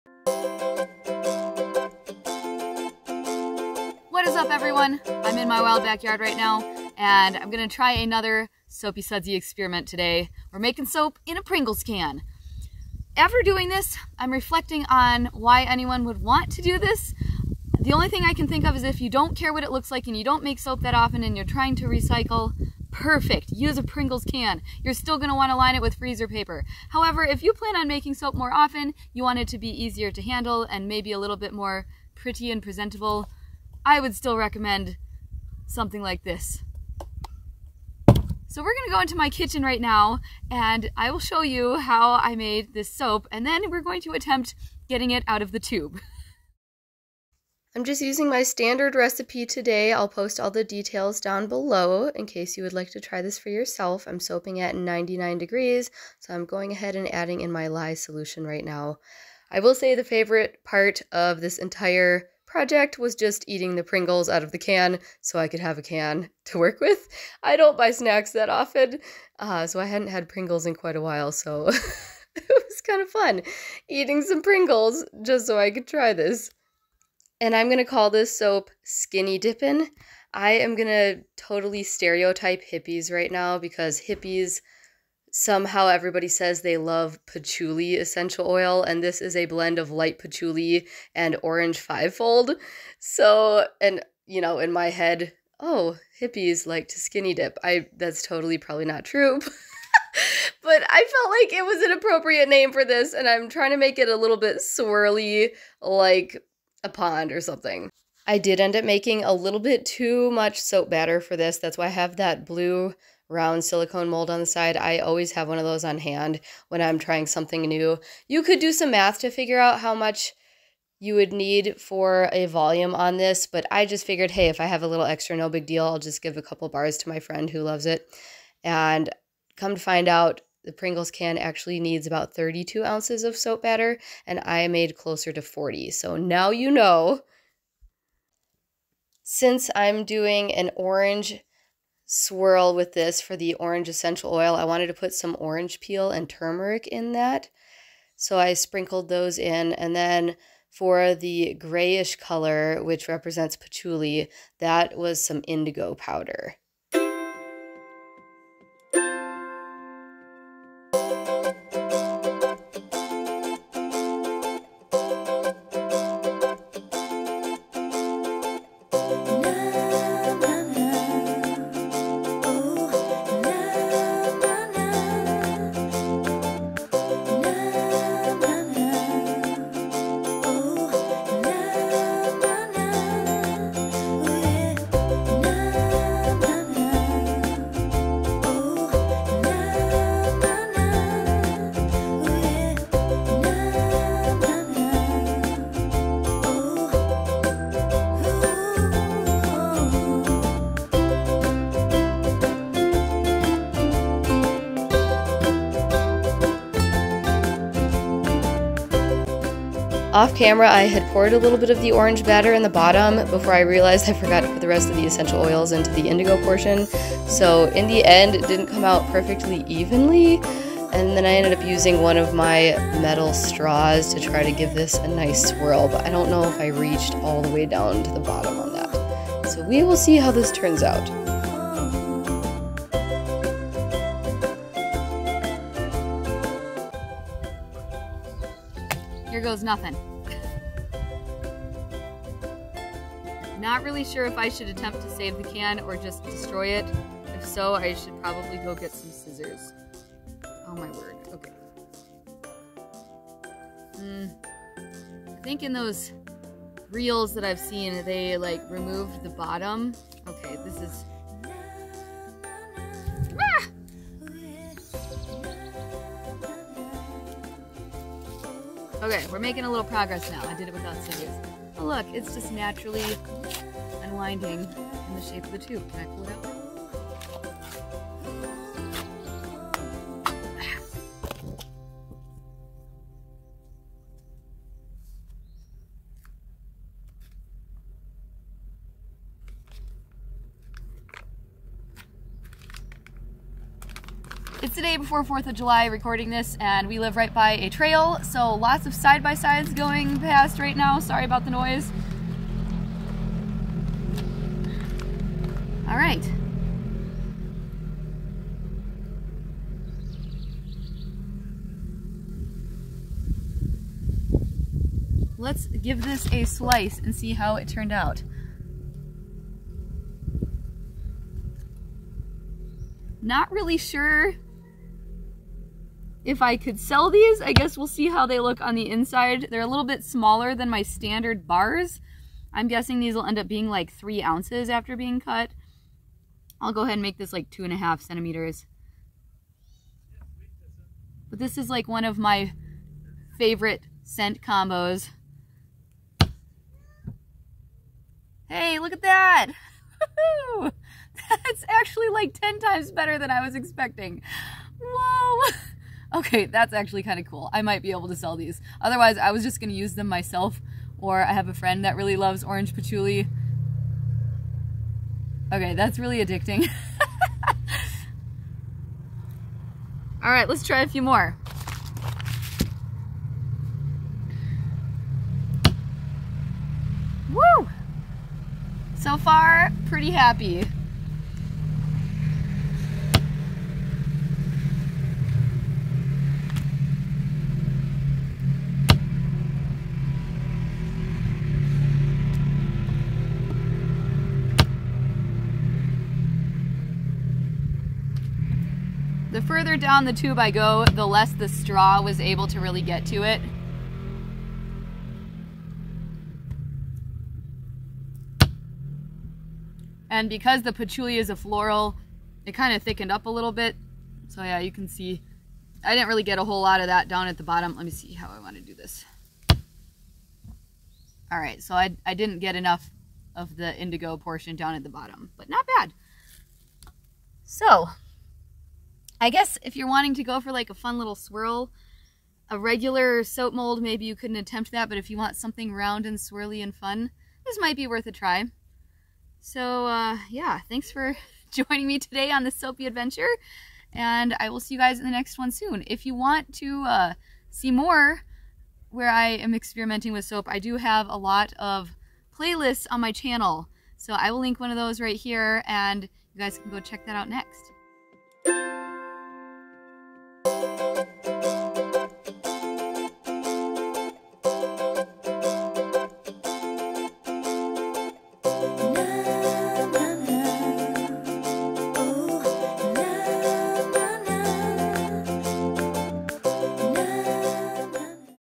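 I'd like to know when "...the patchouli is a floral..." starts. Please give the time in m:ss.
6:50.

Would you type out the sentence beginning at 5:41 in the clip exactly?
But this is like one of my favorite scent combos.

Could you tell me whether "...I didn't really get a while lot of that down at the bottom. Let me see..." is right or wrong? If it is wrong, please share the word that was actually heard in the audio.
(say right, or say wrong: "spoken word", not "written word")
wrong: "whole", not "while".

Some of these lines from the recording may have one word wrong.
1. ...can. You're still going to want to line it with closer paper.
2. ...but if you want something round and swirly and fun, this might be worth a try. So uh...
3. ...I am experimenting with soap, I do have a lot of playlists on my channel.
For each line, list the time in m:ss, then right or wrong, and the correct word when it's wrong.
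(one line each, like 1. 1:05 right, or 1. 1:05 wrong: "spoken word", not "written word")
1. 0:24 wrong: "freezer", not "closer"
2. 7:14 right
3. 7:29 right.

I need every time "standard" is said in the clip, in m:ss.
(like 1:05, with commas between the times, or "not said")
0:48, 5:30.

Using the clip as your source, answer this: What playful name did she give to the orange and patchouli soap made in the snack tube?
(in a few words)
Skinny Dippin'.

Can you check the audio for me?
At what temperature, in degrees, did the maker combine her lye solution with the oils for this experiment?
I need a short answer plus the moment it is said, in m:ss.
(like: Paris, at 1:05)
99, at 0:54.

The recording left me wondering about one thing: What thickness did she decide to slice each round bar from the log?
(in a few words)
2.5 centimeters.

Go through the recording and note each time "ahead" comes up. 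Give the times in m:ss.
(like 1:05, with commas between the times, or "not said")
0:56, 5:36.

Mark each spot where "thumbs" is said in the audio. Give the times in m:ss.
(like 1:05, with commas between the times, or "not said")
not said.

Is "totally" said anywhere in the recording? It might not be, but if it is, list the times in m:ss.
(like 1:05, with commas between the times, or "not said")
1:21, 1:38.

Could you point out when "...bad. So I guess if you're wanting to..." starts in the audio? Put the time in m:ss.
7:05.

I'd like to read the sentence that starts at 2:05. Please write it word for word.
I'll just give a couple bars to my friend who loves it.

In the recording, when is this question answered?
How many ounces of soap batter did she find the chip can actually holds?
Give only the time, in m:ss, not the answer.
2:12.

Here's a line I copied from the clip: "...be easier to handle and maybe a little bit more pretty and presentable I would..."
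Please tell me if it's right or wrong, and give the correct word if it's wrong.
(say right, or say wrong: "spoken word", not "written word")
right.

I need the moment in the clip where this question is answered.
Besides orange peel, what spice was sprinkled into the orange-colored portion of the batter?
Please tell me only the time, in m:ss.
2:26.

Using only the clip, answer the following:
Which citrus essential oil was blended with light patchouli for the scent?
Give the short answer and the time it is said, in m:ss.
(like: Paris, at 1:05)
orange fivefold, at 1:31.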